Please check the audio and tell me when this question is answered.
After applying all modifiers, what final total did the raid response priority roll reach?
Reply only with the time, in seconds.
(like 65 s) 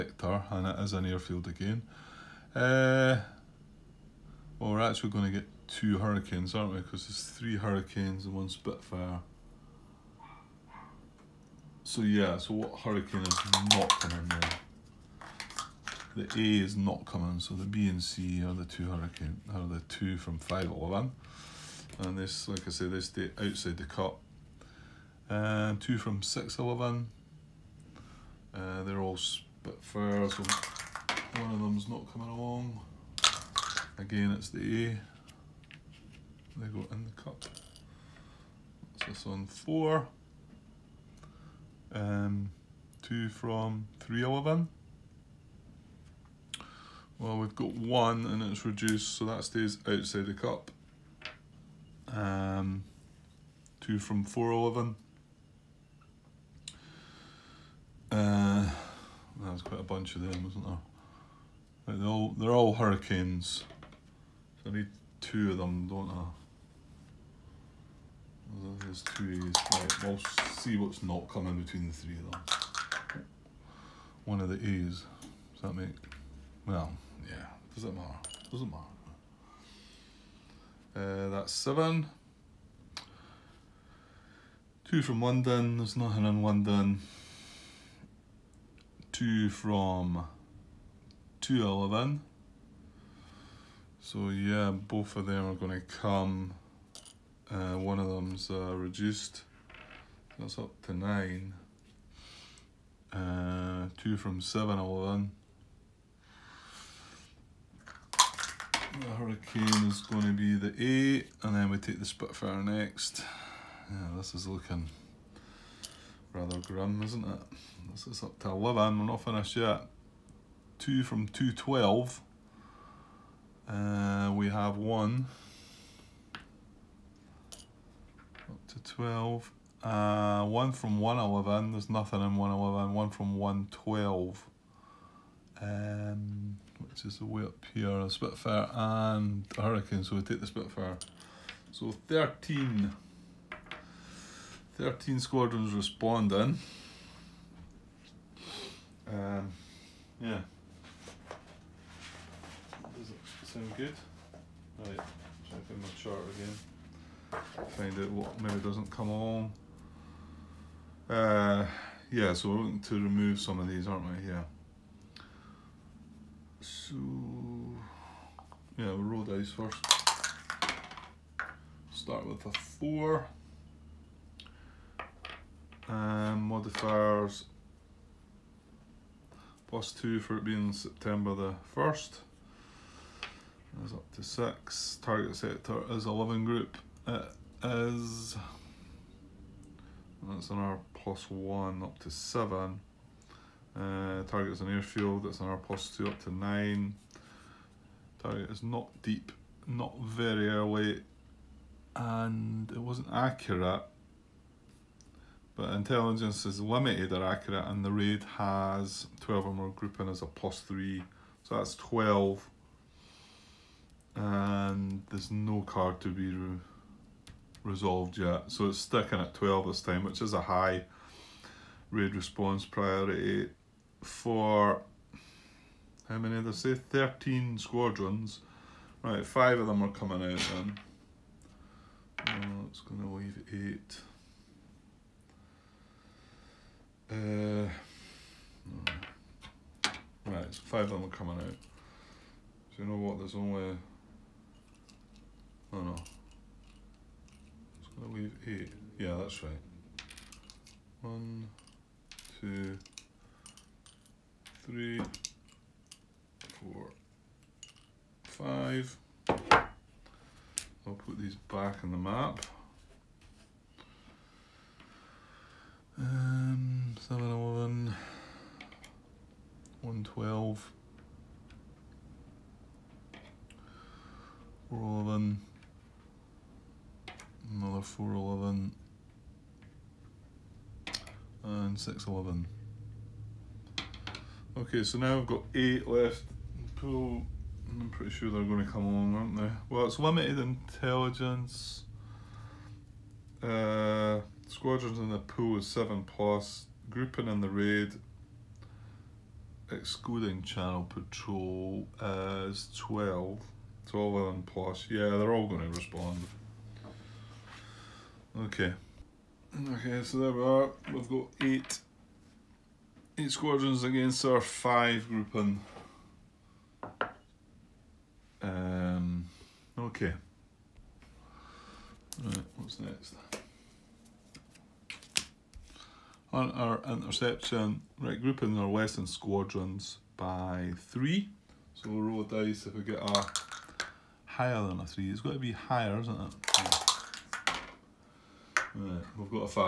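218 s.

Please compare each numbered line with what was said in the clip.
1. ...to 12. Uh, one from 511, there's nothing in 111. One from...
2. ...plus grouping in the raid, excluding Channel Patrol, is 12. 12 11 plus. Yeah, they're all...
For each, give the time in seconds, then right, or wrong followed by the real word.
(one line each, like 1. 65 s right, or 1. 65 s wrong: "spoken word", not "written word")
1. 128 s wrong: "111", not "511"
2. 296 s right.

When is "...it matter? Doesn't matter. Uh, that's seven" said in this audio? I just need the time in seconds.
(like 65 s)
77 s.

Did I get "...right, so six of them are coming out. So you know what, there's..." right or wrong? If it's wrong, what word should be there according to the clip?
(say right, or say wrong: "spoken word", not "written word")
wrong: "five", not "six".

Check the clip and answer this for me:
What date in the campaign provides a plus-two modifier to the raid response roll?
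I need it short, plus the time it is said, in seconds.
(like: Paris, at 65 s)
September 1st, at 180 s.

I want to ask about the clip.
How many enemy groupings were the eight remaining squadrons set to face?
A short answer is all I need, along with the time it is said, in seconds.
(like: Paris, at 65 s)
5, at 314 s.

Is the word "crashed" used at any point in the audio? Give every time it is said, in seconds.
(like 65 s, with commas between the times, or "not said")
not said.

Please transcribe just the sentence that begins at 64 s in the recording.
So I need two of them, don't I?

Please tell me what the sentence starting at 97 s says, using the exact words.
Uh, one of them's uh, reduced.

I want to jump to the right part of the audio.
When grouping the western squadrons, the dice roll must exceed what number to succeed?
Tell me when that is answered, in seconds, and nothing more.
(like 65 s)
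334 s.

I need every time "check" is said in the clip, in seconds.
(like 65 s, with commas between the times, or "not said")
155 s.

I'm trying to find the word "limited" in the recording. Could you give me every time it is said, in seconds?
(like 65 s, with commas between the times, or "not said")
206 s, 289 s.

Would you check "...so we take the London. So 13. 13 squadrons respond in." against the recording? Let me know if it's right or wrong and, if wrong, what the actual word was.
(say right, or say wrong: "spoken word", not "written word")
wrong: "Spitfire", not "London".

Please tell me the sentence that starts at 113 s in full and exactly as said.
Yeah, this is looking rather grim, isn't it?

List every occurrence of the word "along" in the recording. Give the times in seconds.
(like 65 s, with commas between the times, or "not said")
32 s, 288 s.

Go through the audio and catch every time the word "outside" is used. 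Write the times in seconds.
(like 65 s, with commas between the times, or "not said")
23 s, 49 s.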